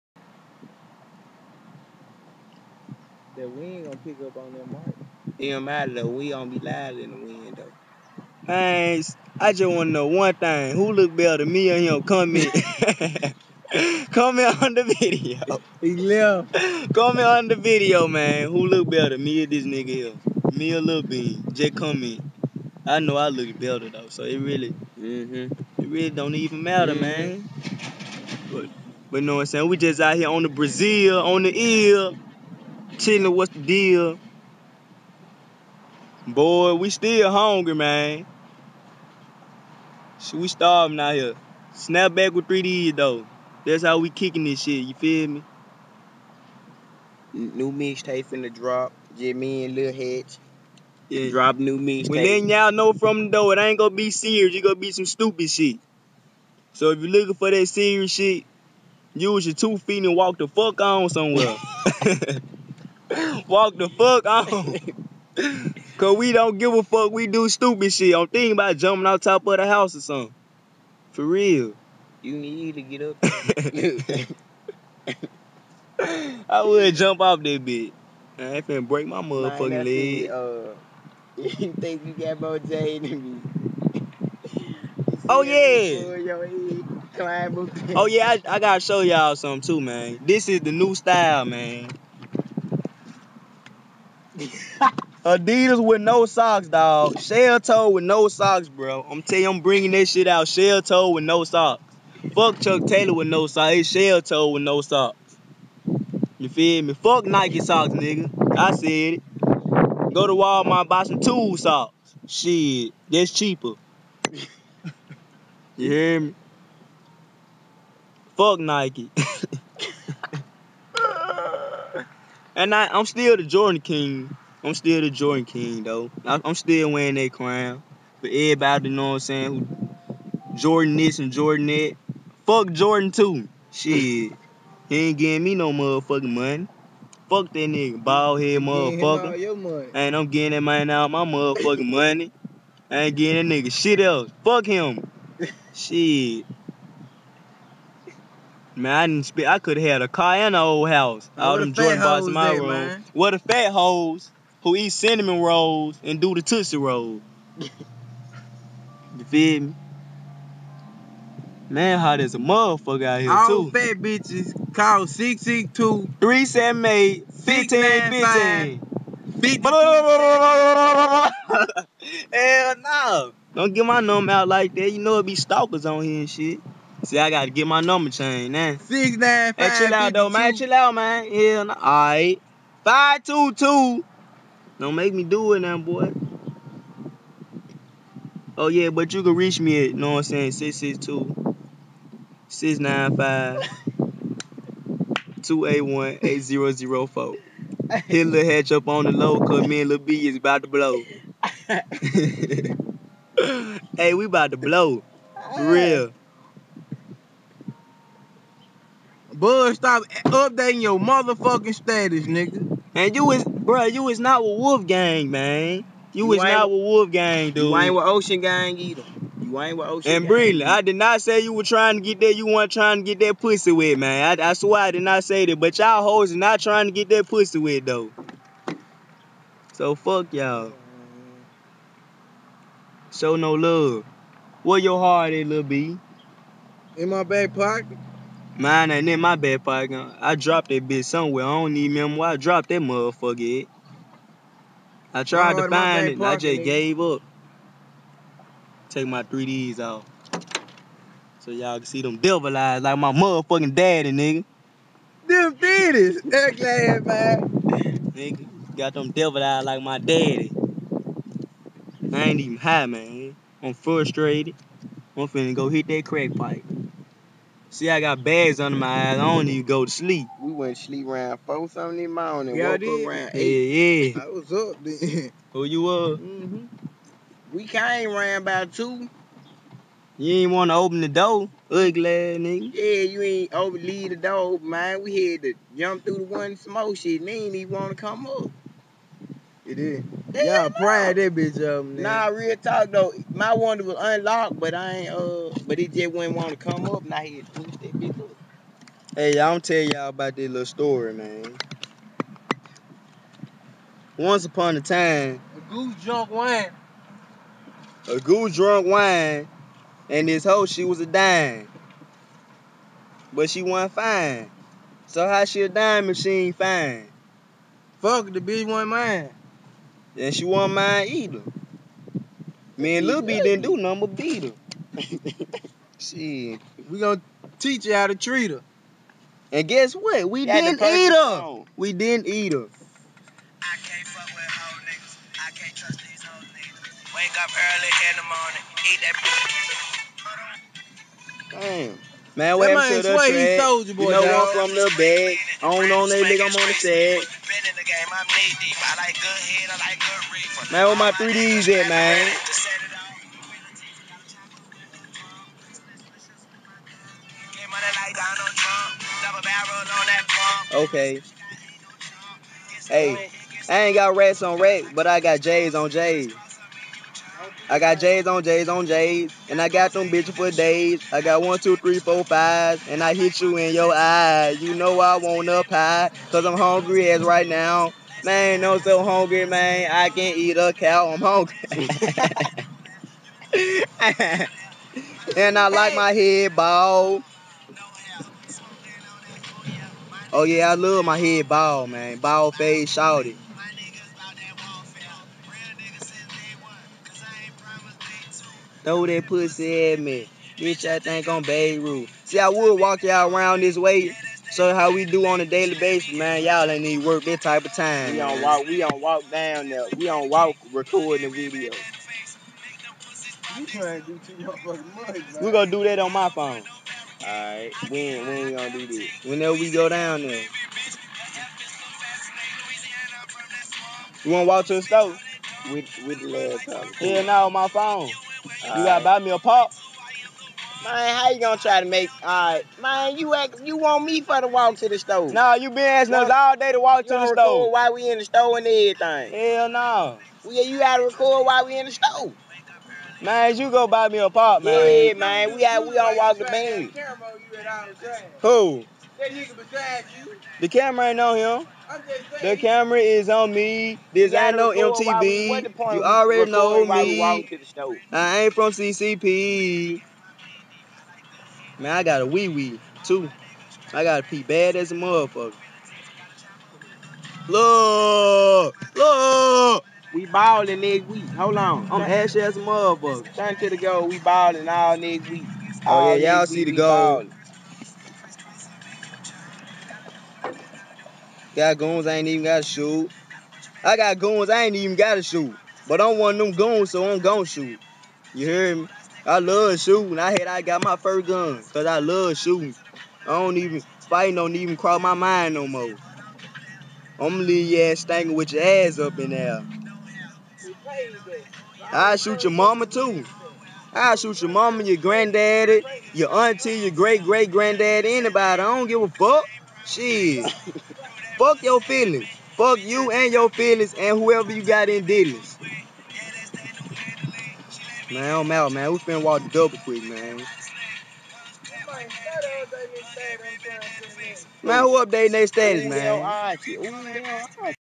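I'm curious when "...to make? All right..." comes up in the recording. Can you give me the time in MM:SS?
07:11.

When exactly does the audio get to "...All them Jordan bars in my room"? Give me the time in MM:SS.
02:31.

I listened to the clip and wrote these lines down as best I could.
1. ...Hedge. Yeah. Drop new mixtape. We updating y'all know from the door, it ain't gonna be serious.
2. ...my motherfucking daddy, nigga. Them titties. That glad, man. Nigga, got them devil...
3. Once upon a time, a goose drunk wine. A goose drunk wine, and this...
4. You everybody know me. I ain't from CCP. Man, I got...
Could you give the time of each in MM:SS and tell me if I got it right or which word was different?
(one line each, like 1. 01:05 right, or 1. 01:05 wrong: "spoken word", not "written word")
1. 00:49 wrong: "letting", not "updating"
2. 04:12 right
3. 05:04 right
4. 07:35 wrong: "already", not "everybody".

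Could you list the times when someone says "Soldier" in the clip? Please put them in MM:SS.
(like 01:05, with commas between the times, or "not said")
05:43.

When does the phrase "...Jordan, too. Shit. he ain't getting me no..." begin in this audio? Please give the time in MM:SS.
02:12.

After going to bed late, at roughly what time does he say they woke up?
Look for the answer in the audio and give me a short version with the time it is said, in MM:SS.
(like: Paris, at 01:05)
8, at 04:33.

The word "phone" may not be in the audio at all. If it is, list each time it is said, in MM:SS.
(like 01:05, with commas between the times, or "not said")
06:56, 07:07.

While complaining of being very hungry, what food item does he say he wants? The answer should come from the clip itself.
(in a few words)
a pie.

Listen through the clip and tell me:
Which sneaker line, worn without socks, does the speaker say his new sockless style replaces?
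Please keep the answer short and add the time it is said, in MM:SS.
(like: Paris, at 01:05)
Chuck Taylor, at 01:42.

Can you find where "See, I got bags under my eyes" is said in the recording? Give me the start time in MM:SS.
04:27.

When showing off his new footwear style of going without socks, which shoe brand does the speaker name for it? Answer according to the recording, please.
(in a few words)
Adidas.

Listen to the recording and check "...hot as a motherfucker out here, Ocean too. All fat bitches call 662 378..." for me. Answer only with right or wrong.
wrong.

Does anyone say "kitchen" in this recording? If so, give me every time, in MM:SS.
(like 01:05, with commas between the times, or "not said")
not said.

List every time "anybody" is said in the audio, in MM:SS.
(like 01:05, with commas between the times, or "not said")
08:28.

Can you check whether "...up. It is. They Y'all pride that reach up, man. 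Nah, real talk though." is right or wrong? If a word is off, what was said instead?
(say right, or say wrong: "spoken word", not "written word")
wrong: "bitch", not "reach".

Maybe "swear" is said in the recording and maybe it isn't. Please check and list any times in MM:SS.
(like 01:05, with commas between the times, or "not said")
03:44.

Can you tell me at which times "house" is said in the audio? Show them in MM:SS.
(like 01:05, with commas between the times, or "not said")
01:09, 02:30.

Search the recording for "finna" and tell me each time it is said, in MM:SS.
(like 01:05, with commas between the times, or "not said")
00:48, 01:18, 04:25, 08:38.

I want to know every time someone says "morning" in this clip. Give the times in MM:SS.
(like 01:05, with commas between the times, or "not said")
04:32, 05:41.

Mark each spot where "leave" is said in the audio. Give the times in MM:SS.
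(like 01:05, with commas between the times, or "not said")
04:43, 08:17.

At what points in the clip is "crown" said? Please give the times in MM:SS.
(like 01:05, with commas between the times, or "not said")
02:07.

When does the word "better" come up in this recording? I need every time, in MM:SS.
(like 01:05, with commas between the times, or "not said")
00:11, 00:18, 00:23.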